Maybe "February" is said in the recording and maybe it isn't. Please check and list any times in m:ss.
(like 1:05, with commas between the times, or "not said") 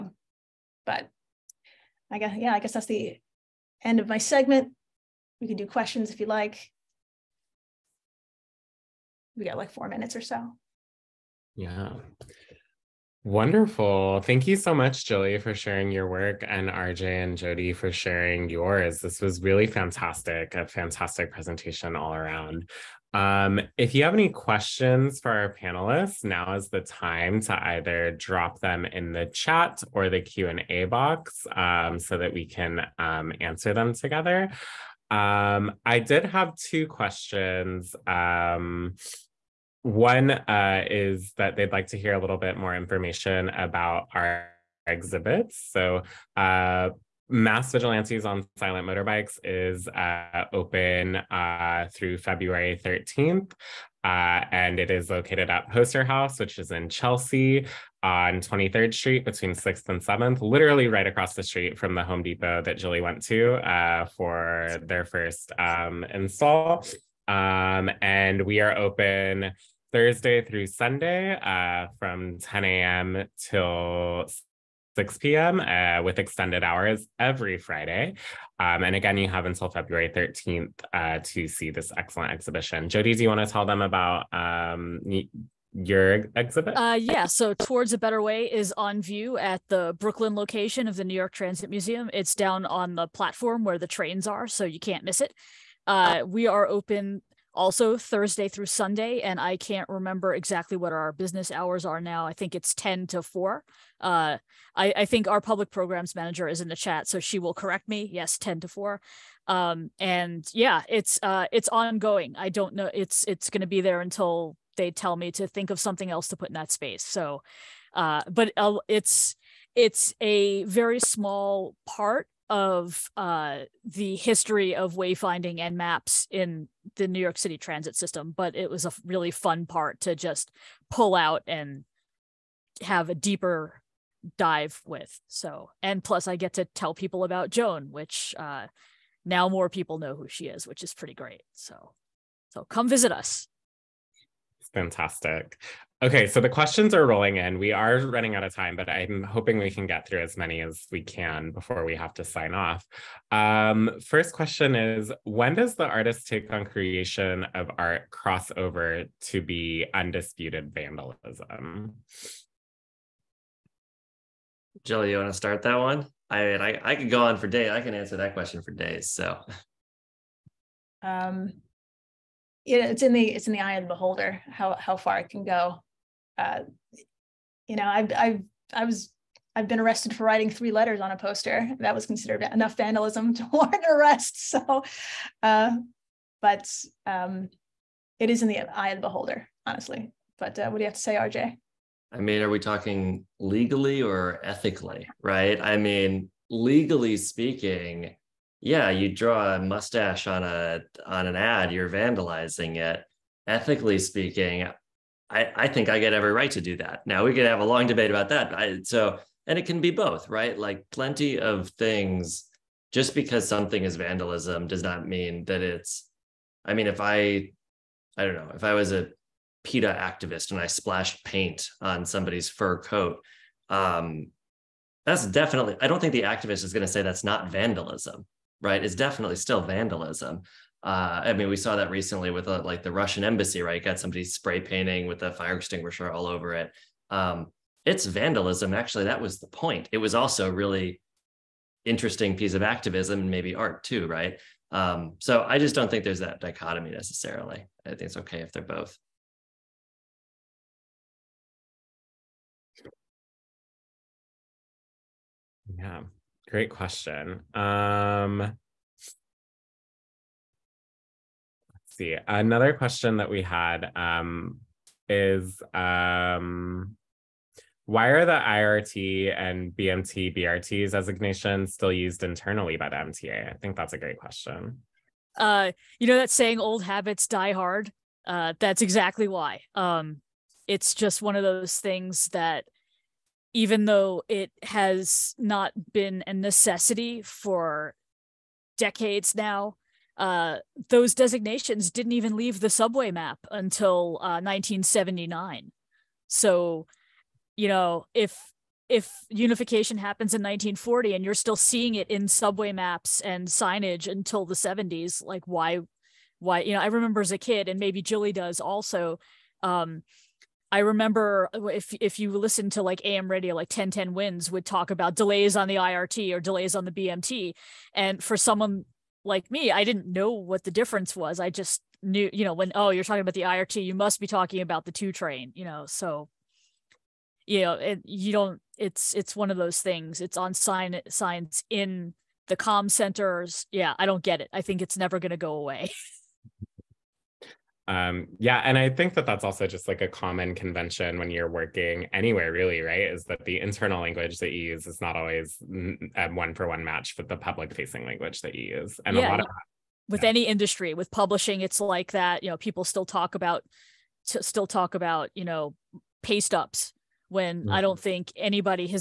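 0:52, 1:19.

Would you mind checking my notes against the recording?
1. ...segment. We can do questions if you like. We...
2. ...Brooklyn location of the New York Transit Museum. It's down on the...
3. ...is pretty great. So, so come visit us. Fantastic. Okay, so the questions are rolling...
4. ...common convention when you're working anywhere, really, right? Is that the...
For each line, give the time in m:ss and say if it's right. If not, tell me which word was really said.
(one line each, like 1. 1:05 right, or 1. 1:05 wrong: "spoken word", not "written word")
1. 0:04 right
2. 1:29 right
3. 2:20 right
4. 5:40 right.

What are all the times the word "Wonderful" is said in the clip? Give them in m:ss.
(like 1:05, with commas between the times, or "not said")
0:13.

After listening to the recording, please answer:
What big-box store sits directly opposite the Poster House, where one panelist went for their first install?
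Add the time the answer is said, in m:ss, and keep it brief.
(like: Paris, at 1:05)
Home Depot, at 1:02.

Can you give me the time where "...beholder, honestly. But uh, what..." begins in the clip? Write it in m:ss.
3:09.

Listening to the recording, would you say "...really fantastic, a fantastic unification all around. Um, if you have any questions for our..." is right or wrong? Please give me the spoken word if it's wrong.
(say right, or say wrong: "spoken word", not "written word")
wrong: "presentation", not "unification".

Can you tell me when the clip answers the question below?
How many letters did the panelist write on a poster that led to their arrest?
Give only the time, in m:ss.
3:00.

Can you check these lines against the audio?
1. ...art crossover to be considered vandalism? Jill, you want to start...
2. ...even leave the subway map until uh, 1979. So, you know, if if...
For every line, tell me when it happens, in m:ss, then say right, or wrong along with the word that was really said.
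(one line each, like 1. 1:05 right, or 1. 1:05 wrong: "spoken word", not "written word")
1. 2:37 wrong: "undisputed", not "considered"
2. 4:52 right.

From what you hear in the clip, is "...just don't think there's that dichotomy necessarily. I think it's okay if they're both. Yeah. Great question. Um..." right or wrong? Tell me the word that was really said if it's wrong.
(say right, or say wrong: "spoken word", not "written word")
right.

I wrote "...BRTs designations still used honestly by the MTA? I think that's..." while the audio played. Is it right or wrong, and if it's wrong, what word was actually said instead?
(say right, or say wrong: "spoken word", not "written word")
wrong: "internally", not "honestly".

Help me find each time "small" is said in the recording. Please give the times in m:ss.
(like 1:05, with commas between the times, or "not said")
2:00.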